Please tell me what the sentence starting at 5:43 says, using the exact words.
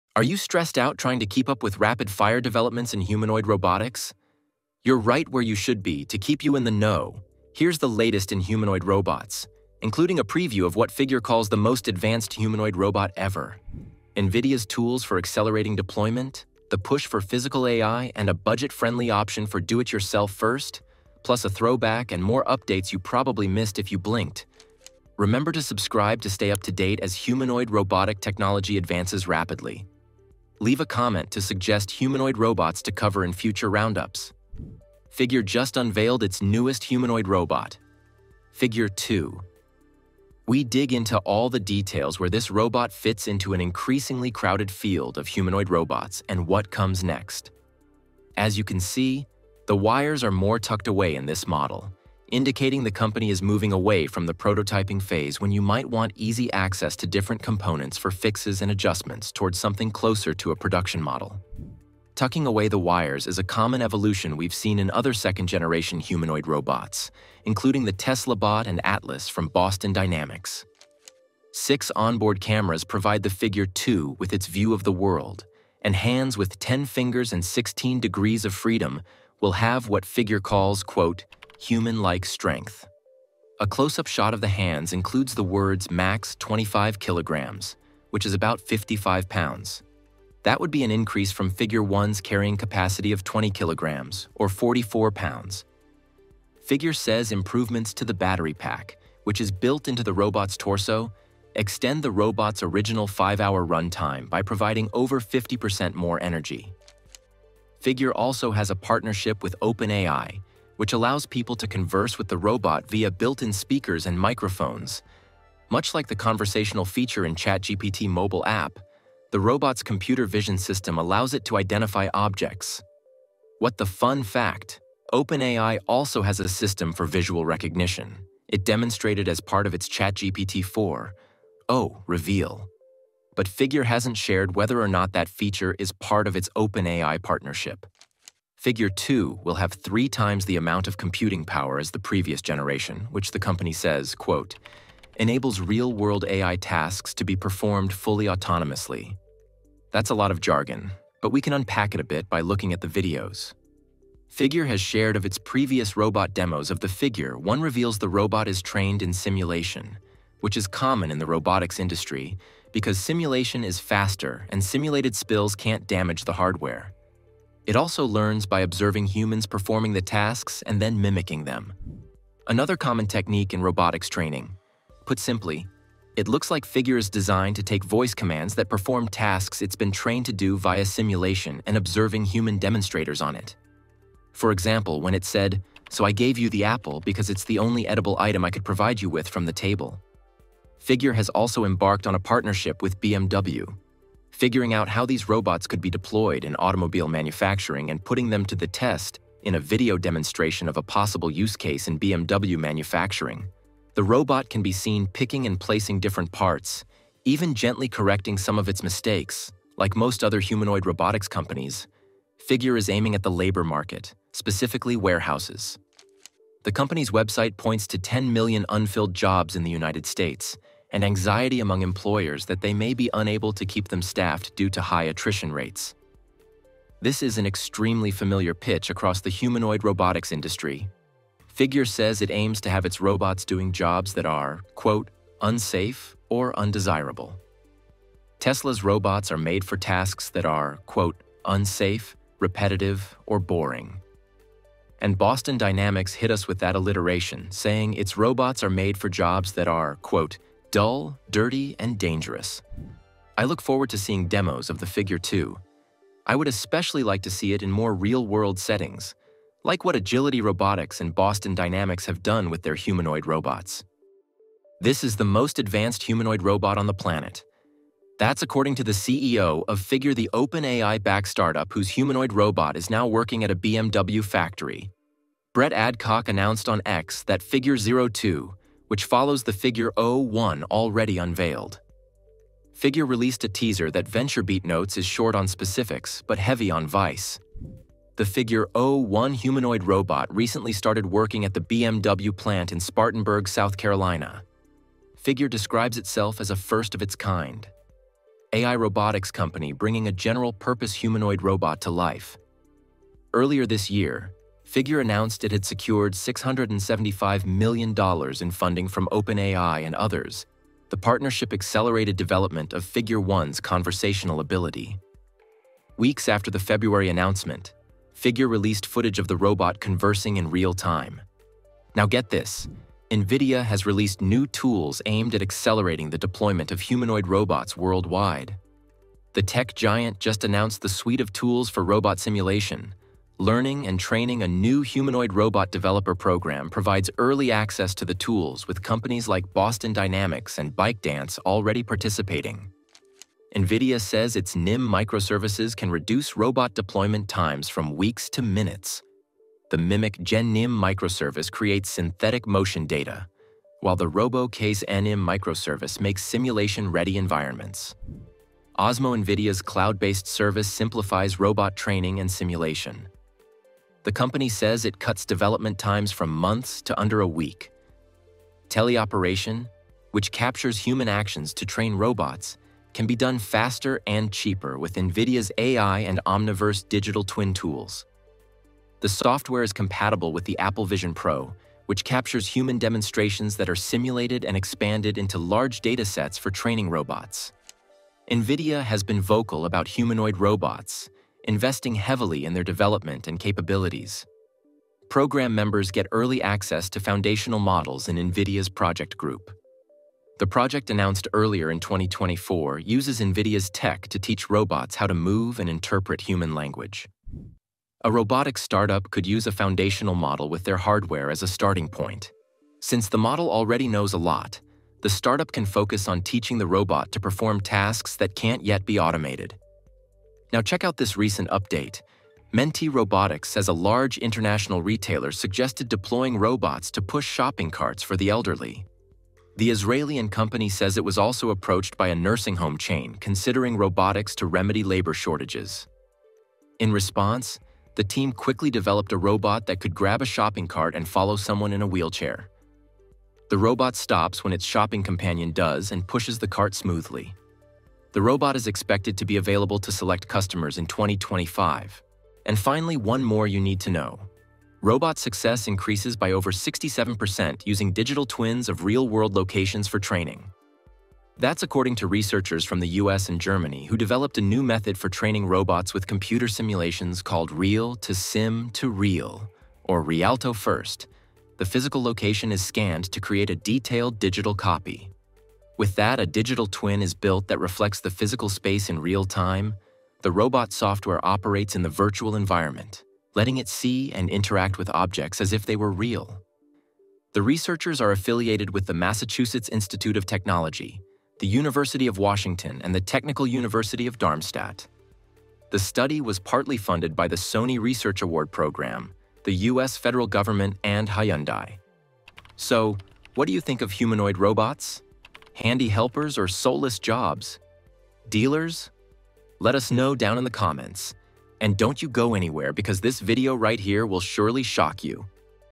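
NVIDIA says its NIM microservices can reduce robot deployment times from weeks to minutes.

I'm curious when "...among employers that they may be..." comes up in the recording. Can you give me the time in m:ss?
3:41.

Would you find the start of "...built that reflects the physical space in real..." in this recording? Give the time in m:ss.
7:57.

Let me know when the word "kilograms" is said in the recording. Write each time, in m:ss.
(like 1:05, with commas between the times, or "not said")
1:26, 1:33.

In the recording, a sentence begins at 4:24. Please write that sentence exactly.
This is the most advanced humanoid robot on the planet.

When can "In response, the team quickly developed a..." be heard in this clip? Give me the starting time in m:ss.
7:16.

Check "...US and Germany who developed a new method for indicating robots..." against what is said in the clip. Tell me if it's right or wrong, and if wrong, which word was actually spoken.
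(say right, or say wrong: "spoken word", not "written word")
wrong: "training", not "indicating".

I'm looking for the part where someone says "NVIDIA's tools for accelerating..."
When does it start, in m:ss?
0:14.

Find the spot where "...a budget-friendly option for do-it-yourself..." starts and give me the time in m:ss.
0:18.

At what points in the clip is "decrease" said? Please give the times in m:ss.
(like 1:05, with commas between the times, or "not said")
not said.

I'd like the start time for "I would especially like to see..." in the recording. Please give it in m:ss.
4:16.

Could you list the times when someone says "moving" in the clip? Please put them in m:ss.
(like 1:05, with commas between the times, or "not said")
0:53.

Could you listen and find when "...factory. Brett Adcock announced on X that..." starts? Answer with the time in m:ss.
4:34.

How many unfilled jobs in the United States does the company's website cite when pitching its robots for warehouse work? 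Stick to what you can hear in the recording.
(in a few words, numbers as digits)
10 million.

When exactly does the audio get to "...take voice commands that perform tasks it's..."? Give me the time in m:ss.
2:57.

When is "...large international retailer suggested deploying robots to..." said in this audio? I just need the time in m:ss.
7:03.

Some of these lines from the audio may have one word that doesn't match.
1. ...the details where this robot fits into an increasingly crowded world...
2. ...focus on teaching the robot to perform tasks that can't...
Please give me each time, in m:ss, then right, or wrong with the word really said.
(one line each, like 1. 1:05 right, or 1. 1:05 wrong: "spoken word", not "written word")
1. 0:41 wrong: "field", not "world"
2. 6:55 right.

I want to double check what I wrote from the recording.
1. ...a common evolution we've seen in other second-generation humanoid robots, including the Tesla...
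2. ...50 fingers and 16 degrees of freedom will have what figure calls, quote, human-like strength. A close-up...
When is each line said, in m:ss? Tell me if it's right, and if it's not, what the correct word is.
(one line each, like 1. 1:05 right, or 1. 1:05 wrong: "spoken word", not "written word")
1. 1:03 right
2. 1:16 wrong: "10", not "50".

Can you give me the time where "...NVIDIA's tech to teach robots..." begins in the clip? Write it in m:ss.
6:43.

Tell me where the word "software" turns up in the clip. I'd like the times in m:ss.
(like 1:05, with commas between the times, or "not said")
6:19, 8:00.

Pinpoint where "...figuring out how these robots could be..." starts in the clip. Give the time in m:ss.
3:14.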